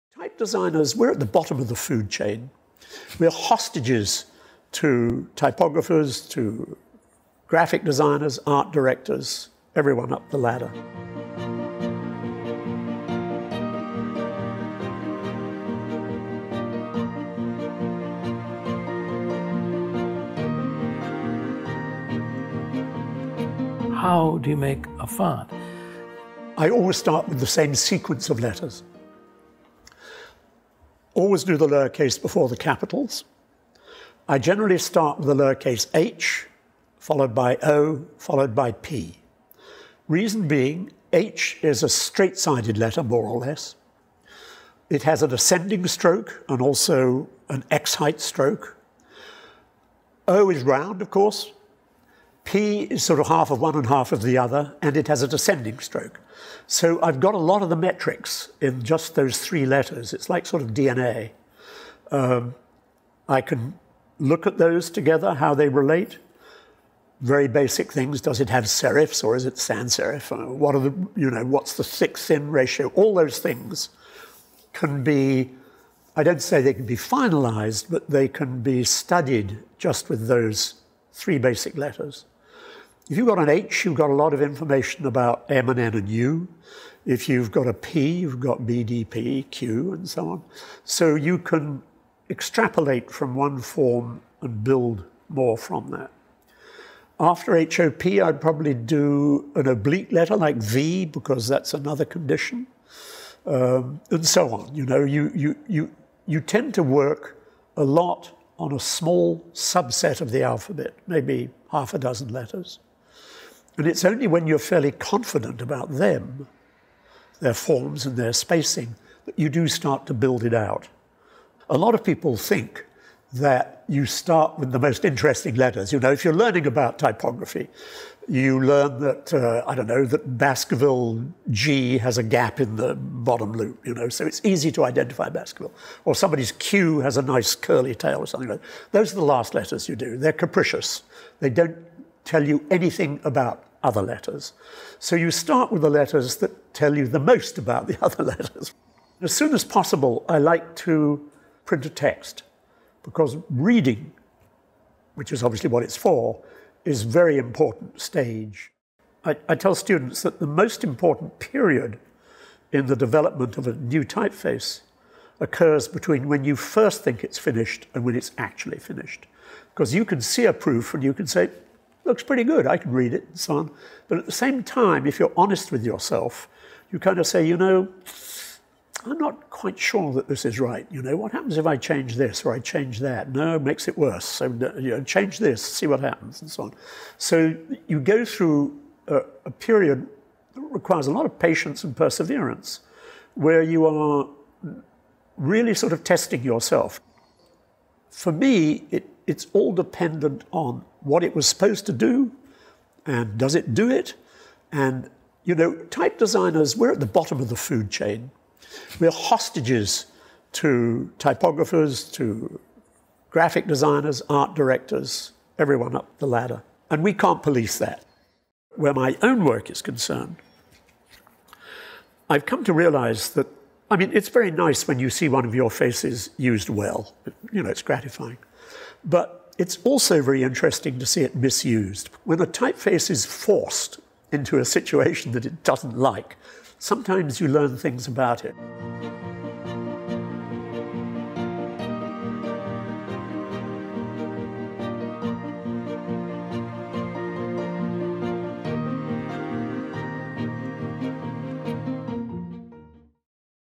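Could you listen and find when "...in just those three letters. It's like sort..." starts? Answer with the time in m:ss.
0:58.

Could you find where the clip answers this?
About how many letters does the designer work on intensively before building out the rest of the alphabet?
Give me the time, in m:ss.
1:51.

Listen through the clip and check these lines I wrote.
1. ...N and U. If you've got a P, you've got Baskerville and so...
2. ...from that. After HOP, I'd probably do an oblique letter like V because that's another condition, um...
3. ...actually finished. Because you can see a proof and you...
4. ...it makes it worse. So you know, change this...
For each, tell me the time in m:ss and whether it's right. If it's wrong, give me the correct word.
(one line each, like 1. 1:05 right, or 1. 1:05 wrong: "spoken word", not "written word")
1. 1:25 wrong: "BDPQ", not "Baskerville"
2. 1:35 right
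3. 2:48 right
4. 3:03 right.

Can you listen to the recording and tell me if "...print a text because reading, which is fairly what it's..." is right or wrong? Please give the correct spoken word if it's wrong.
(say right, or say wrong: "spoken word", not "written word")
wrong: "obviously", not "fairly".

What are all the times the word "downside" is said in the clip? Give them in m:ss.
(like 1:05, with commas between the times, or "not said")
not said.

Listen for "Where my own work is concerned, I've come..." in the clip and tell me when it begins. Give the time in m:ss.
3:38.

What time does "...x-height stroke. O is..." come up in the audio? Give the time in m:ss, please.
0:47.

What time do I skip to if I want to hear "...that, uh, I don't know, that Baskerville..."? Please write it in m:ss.
2:08.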